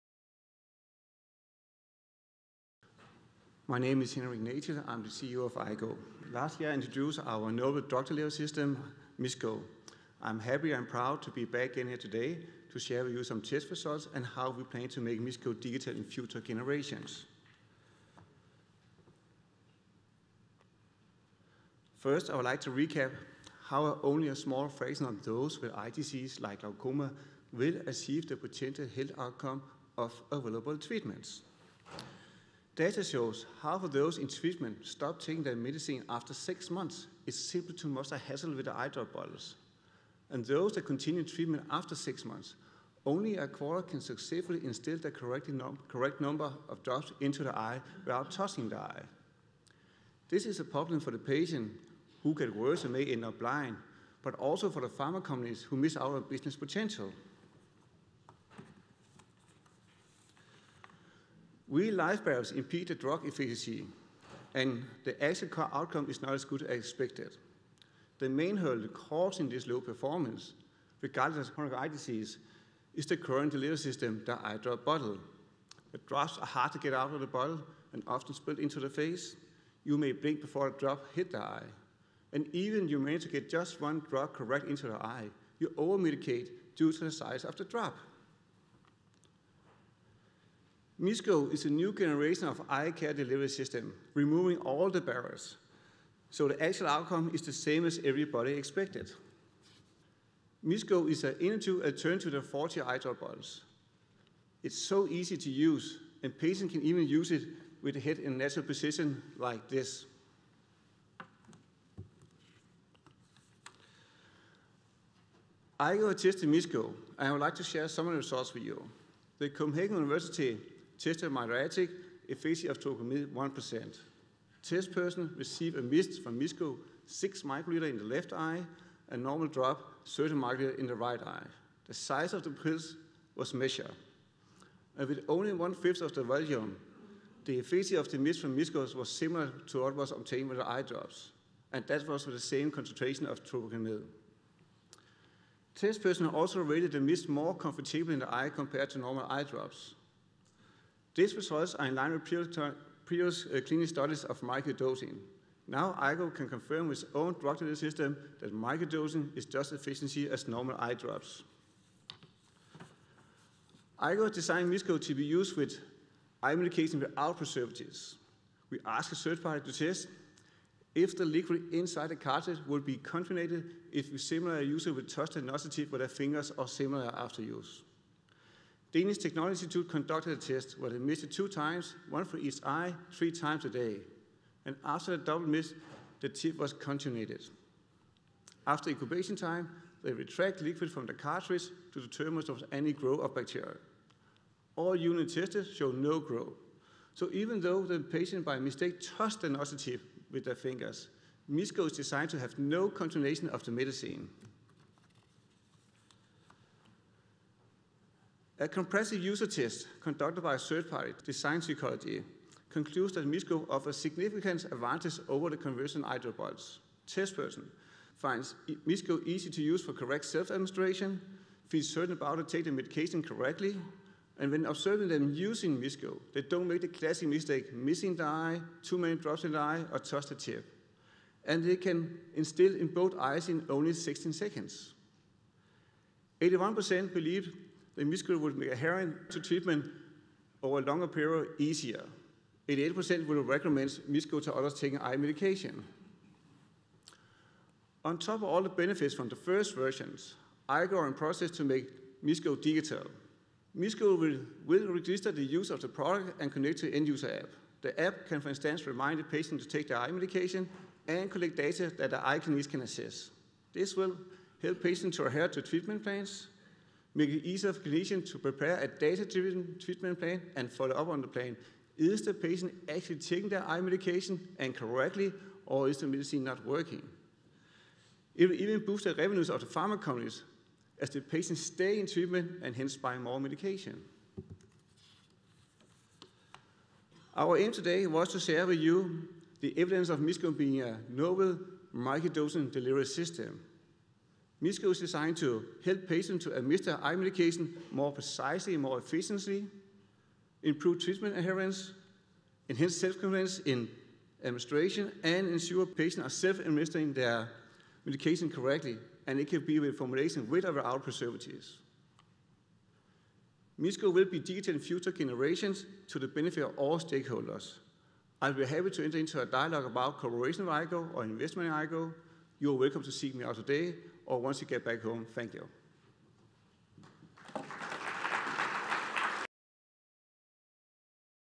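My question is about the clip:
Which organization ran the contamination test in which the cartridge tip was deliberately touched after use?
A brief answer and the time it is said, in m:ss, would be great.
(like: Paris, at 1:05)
Danish Technology Institute, at 2:58.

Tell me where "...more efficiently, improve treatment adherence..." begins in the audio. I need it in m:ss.
4:58.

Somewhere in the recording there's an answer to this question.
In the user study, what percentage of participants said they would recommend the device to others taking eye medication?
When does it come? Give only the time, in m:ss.
4:02.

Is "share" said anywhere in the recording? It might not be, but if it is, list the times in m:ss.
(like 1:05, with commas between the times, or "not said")
0:12, 1:57, 4:48.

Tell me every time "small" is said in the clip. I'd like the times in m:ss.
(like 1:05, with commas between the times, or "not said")
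0:24.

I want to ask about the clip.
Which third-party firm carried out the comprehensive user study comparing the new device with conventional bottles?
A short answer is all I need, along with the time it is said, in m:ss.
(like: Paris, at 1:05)
Design Psychology, at 3:31.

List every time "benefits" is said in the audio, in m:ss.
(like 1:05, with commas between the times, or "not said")
4:08, 5:16.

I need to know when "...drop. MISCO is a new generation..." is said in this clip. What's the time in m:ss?
1:27.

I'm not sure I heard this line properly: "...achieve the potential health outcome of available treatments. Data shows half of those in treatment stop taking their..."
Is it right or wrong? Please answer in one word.
right.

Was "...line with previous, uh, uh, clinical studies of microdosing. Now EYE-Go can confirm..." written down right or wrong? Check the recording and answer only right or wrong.
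right.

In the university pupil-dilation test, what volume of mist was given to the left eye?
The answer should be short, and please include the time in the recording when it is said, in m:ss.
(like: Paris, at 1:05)
6 microliters, at 2:07.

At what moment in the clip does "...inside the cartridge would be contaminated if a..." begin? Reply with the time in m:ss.
2:51.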